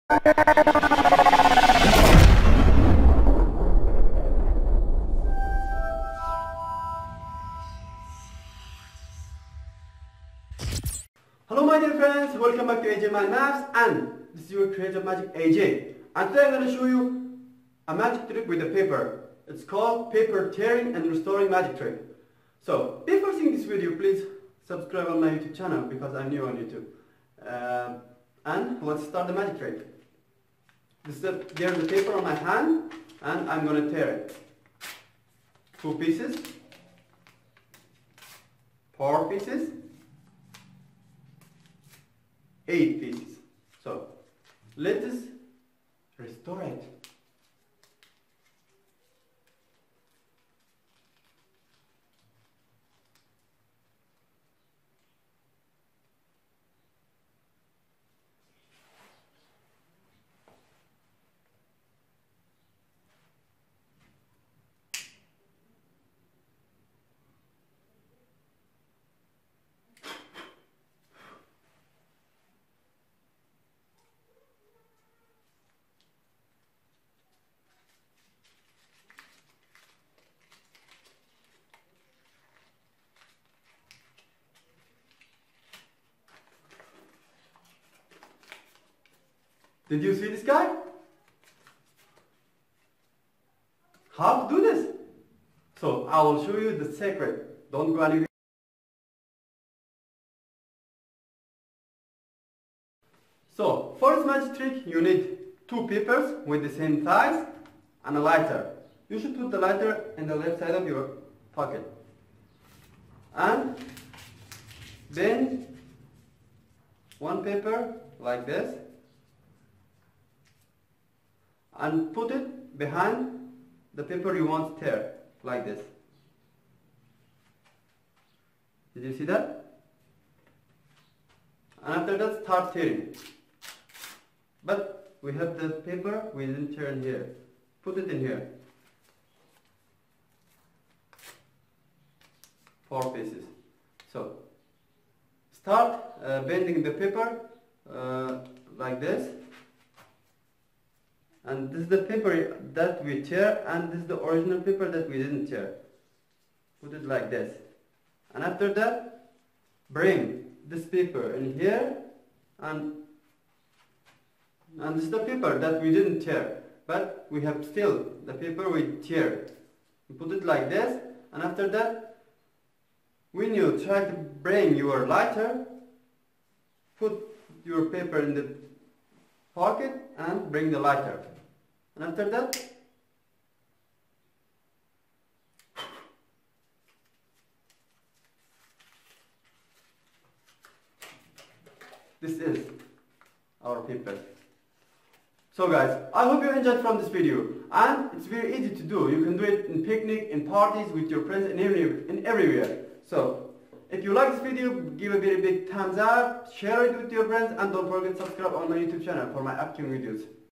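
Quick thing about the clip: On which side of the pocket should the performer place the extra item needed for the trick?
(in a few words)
Left side.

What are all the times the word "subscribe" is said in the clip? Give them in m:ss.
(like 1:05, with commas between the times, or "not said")
0:24, 3:28.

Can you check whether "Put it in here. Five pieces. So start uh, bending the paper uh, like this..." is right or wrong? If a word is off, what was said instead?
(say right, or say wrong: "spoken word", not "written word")
wrong: "Four", not "Five".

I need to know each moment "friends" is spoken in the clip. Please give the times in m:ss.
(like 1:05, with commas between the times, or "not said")
0:11, 3:21, 3:27.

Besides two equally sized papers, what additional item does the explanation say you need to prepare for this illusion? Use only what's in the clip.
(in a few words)
A lighter.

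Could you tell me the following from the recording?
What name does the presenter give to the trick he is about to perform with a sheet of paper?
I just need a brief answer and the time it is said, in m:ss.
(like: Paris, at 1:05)
Paper tearing and restoring, at 0:20.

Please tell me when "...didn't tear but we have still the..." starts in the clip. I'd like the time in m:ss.
2:45.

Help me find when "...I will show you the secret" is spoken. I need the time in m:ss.
1:36.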